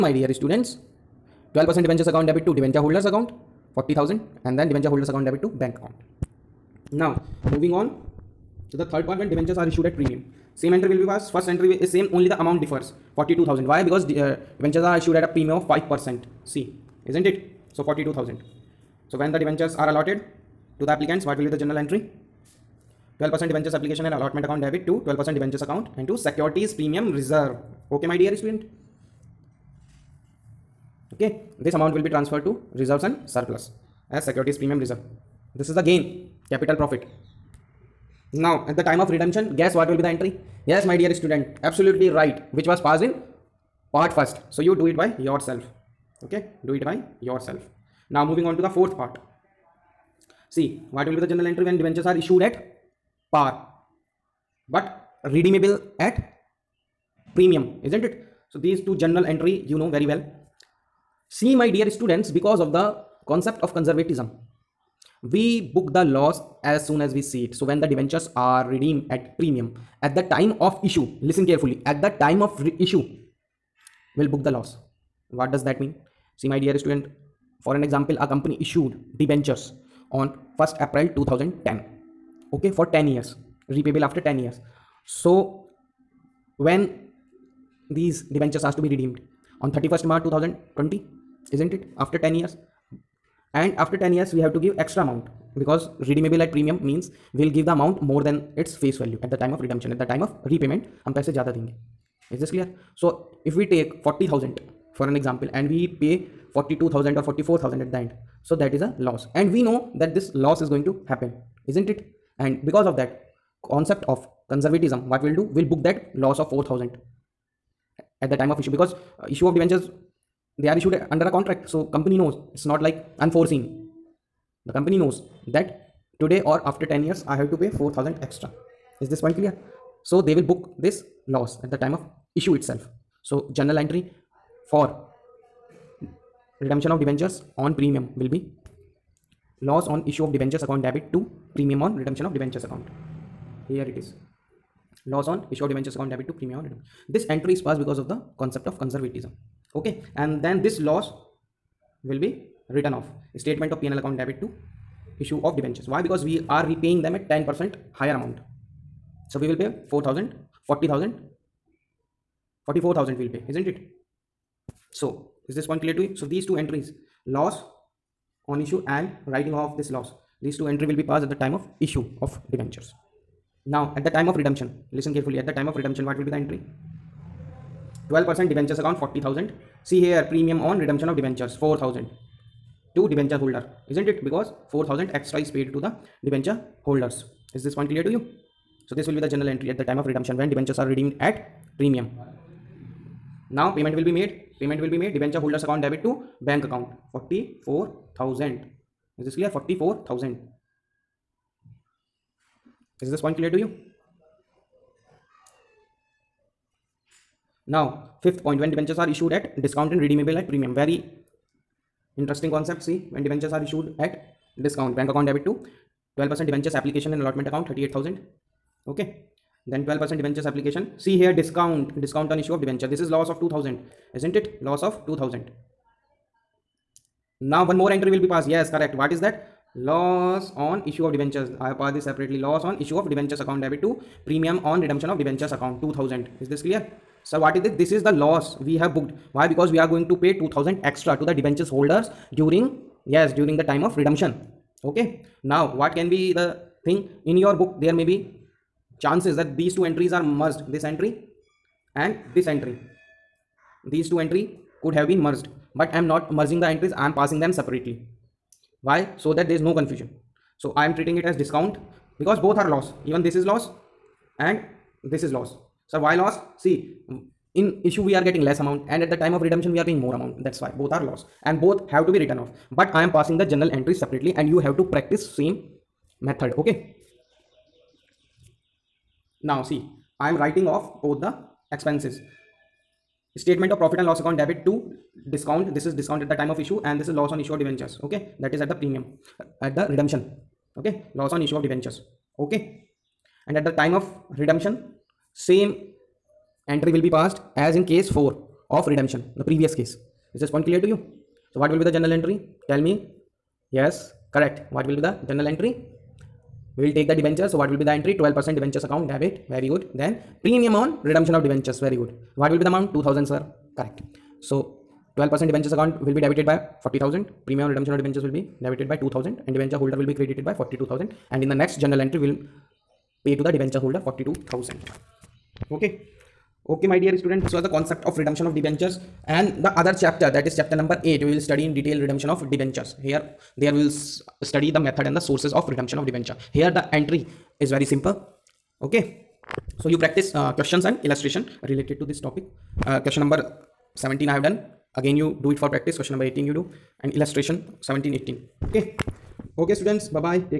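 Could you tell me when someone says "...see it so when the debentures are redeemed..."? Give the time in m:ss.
1:07.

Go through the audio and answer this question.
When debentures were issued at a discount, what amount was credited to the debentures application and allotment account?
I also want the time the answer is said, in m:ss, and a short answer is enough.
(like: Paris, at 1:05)
38000, at 3:37.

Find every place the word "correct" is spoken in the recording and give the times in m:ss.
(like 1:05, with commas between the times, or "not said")
3:48, 5:04, 5:13.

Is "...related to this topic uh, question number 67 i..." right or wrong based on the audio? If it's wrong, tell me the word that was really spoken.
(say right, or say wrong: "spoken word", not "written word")
wrong: "17", not "67".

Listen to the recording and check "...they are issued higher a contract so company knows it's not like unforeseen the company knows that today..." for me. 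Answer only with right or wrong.
wrong.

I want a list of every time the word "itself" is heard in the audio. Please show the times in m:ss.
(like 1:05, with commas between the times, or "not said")
2:12.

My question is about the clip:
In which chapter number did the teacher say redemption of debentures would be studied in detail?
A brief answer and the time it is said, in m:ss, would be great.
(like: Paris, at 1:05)
Chapter 8, at 5:30.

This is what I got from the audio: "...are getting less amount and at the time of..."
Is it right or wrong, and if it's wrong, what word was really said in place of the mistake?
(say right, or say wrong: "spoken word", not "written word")
right.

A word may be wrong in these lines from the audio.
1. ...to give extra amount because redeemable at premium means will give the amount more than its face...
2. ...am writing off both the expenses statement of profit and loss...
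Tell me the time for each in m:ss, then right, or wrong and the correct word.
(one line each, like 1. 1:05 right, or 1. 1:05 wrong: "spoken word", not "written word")
1. 1:34 right
2. 4:40 right.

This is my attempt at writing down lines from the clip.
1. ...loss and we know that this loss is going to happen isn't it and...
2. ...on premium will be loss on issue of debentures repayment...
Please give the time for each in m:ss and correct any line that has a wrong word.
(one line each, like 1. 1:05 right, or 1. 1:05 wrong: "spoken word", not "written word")
1. 1:49 right
2. 2:17 wrong: "account", not "repayment".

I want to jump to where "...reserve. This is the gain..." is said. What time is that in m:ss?
0:34.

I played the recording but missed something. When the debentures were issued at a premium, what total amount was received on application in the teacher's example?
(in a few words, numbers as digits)
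42000.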